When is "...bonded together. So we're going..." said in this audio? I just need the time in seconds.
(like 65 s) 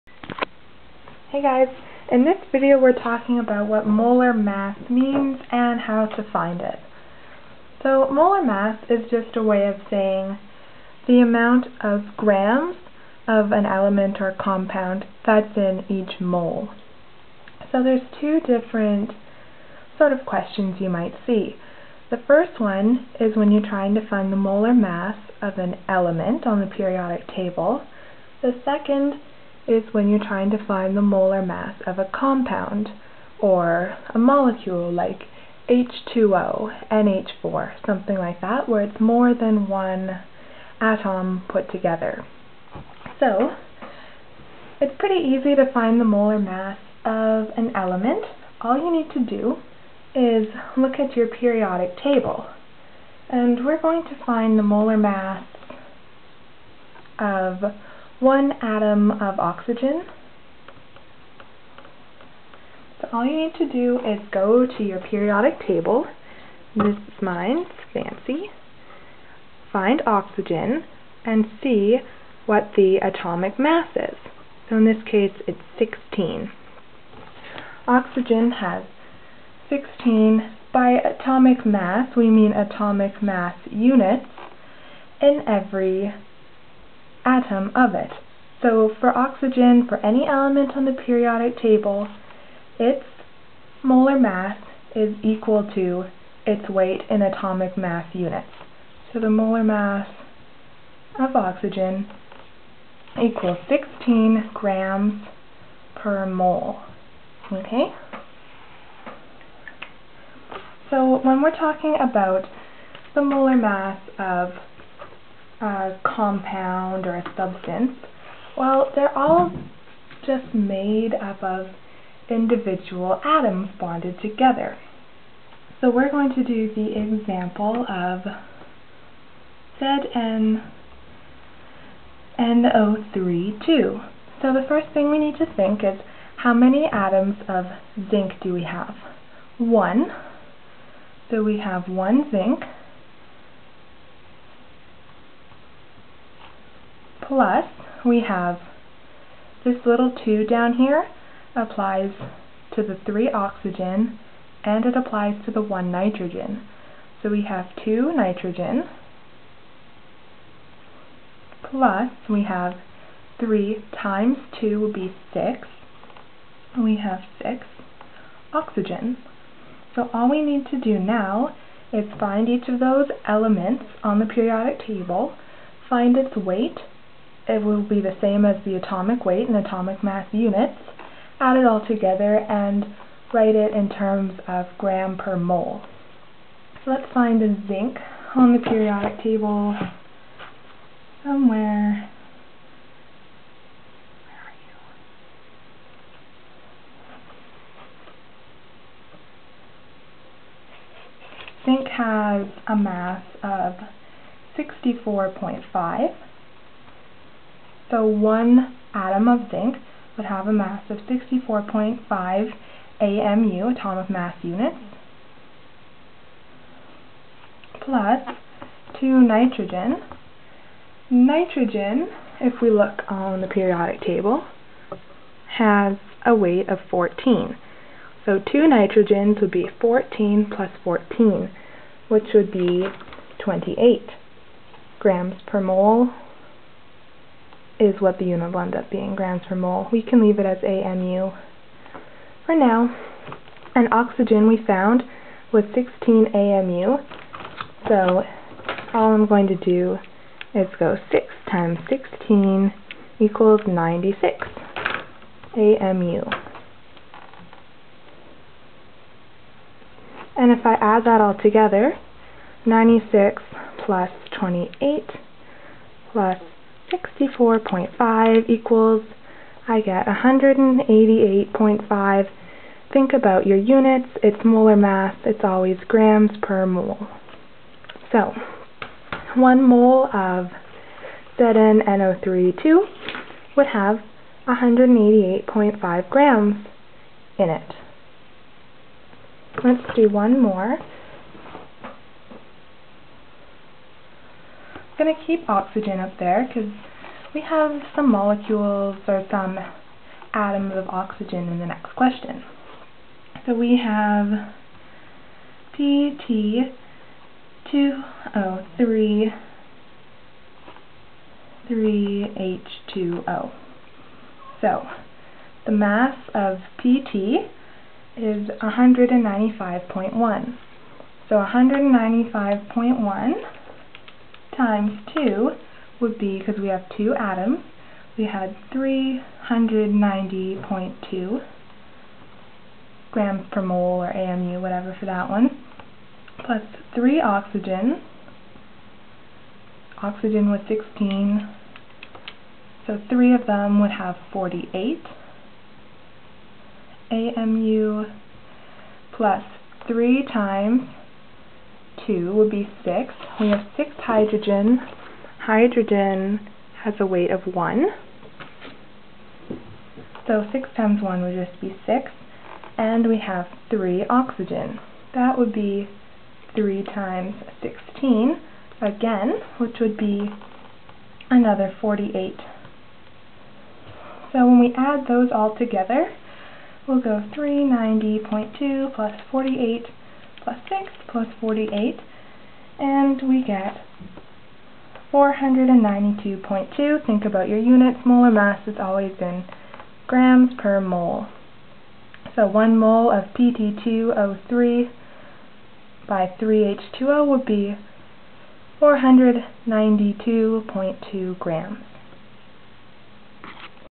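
123 s.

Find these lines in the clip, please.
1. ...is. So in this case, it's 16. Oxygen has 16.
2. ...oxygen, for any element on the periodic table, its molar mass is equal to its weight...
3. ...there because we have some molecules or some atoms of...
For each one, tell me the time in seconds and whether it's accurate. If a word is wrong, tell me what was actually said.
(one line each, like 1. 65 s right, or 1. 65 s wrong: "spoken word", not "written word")
1. 73 s right
2. 89 s right
3. 296 s right.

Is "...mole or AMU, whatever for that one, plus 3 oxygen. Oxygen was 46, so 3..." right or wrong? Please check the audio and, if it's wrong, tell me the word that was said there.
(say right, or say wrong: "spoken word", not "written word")
wrong: "16", not "46".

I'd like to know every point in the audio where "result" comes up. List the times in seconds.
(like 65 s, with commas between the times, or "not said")
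not said.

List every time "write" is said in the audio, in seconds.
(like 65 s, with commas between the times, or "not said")
183 s.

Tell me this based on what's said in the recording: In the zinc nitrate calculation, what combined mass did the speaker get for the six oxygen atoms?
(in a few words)
96 AMU.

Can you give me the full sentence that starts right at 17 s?
So there's two different sort of questions you might see.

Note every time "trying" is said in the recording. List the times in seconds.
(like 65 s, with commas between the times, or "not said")
23 s, 30 s.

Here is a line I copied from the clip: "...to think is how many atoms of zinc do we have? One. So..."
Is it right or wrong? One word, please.
right.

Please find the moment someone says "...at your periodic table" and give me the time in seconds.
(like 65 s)
50 s.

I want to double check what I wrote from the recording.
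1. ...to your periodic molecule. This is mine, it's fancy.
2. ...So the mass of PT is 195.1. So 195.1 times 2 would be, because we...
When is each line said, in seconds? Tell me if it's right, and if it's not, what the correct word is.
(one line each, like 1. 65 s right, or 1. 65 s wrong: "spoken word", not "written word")
1. 64 s wrong: "table", not "molecule"
2. 314 s right.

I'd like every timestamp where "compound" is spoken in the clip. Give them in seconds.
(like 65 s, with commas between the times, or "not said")
14 s, 32 s, 116 s.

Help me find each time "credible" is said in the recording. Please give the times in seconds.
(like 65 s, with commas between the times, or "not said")
not said.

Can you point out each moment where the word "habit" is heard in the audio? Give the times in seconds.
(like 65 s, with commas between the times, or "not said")
not said.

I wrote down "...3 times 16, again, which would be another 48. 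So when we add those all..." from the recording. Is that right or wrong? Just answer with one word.
right.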